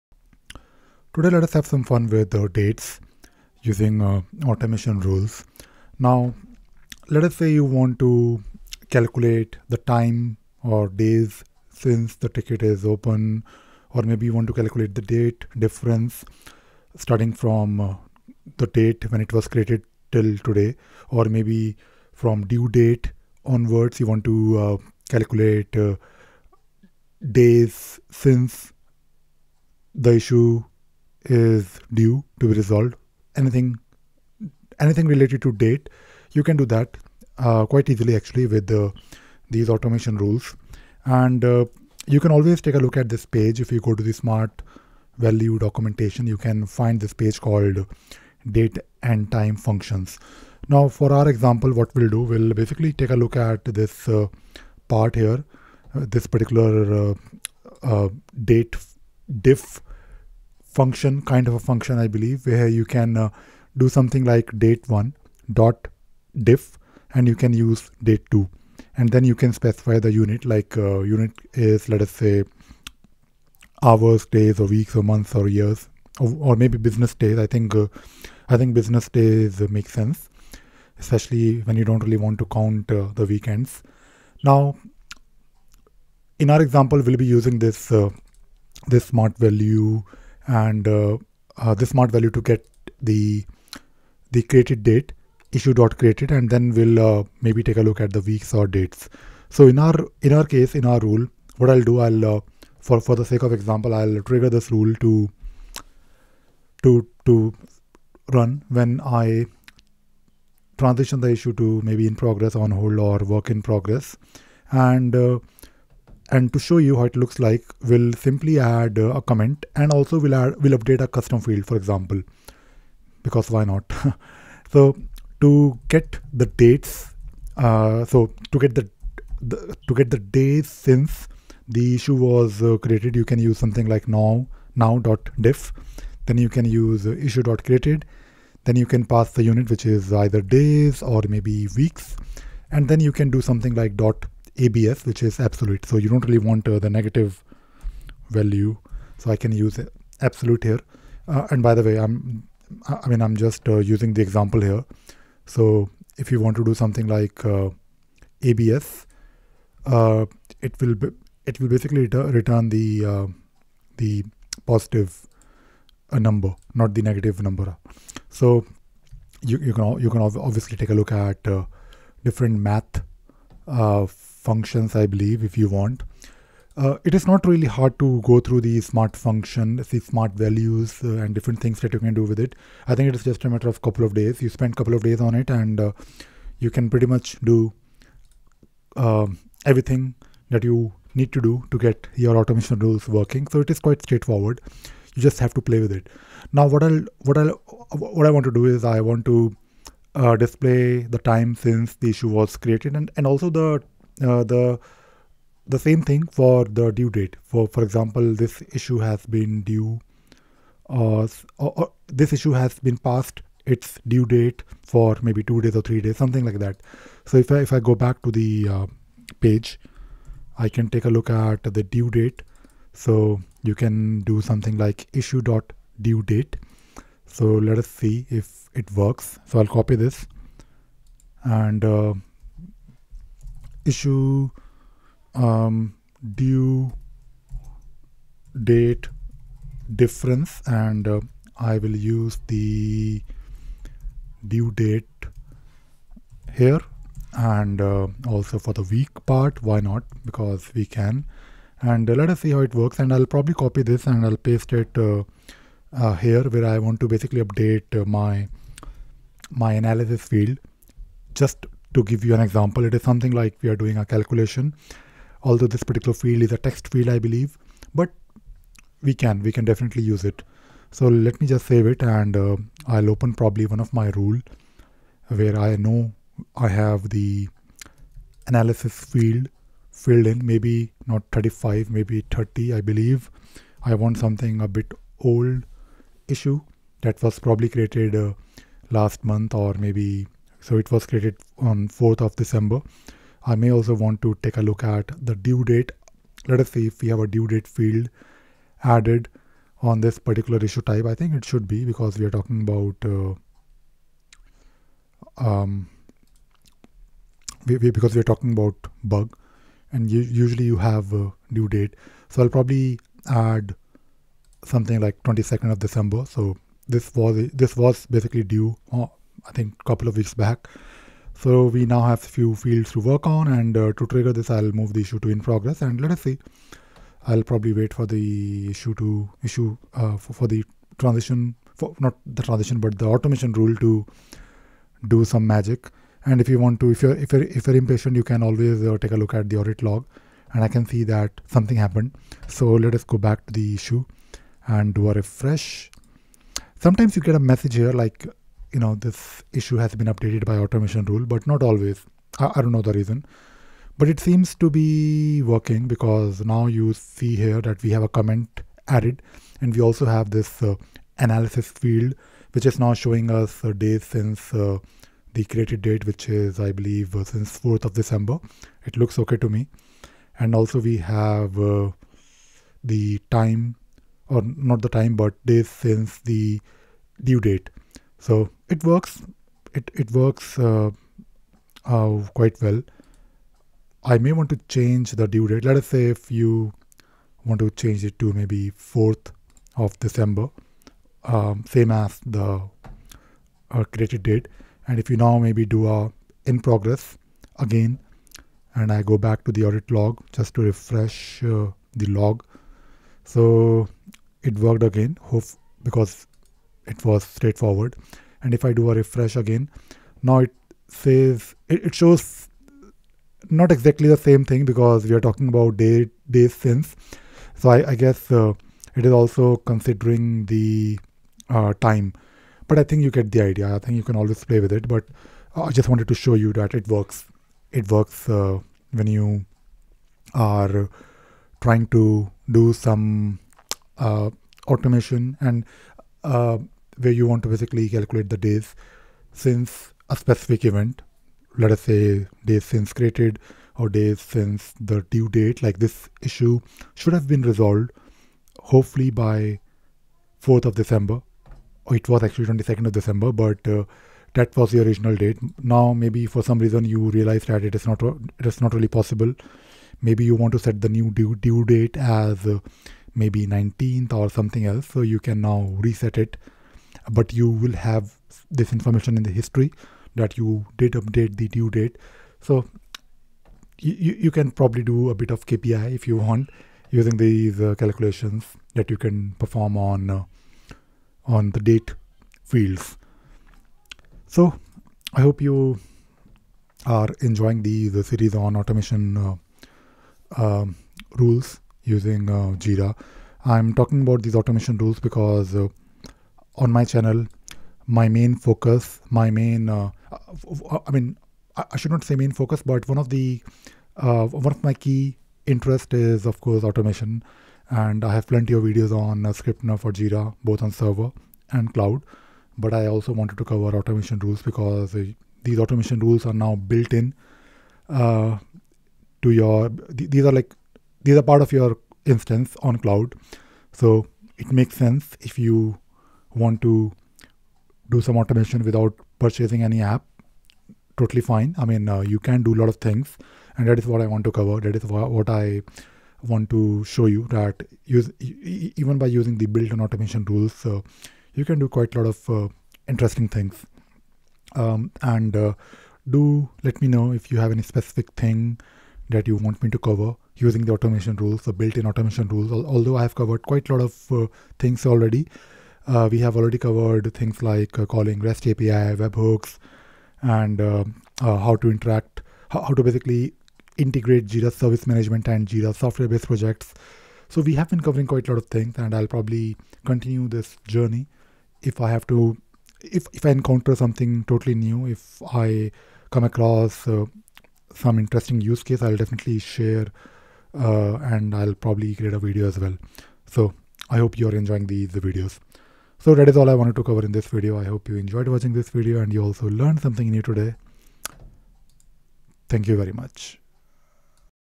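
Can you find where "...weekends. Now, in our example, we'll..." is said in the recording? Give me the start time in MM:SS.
01:23.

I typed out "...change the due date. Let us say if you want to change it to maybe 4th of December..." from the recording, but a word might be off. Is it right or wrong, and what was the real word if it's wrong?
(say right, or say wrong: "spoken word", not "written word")
right.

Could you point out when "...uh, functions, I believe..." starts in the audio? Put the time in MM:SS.
02:53.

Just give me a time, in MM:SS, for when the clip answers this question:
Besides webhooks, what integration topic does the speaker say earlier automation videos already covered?
09:18.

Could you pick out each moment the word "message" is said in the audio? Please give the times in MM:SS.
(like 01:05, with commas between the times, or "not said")
05:47.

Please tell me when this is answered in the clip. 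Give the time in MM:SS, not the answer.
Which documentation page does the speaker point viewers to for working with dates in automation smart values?
00:48.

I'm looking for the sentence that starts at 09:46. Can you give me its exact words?
So that is all I wanted to cover in this video.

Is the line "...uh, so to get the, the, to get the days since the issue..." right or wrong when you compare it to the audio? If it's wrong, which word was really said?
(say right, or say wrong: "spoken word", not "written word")
right.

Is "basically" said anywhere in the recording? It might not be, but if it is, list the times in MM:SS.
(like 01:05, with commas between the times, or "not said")
00:52, 02:41, 04:17, 05:18, 07:17, 09:22.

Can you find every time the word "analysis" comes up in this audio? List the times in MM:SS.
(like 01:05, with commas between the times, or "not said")
04:19, 04:38, 06:01.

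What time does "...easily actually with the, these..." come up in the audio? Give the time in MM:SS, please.
00:37.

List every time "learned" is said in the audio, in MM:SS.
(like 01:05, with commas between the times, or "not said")
09:49.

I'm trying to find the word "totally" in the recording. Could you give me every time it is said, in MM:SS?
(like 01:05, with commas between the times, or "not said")
08:50, 09:34.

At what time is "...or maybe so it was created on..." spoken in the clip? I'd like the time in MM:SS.
04:49.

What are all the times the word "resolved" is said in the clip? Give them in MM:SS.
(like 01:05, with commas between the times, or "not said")
00:32, 07:27.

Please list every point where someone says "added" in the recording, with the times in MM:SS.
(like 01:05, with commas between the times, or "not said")
04:58, 05:58.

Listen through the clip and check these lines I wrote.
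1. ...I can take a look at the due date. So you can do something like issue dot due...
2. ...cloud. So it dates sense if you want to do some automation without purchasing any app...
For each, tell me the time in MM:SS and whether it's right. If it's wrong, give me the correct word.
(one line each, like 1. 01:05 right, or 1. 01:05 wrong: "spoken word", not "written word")
1. 03:40 right
2. 08:42 wrong: "makes", not "dates".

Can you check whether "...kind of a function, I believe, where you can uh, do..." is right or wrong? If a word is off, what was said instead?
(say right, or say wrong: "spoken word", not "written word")
right.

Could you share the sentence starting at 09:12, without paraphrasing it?
Although I have covered quite a lot of uh, things already.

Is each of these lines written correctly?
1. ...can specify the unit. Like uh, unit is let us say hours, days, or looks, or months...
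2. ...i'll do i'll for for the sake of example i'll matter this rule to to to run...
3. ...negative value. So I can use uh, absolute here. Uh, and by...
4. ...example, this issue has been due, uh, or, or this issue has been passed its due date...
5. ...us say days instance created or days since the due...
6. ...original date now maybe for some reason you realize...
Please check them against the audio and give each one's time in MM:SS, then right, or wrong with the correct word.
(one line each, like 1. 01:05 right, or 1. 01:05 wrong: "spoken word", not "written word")
1. 01:09 wrong: "weeks", not "looks"
2. 01:41 wrong: "trigger", not "matter"
3. 02:26 right
4. 03:27 right
5. 07:21 wrong: "since", not "instance"
6. 07:34 right.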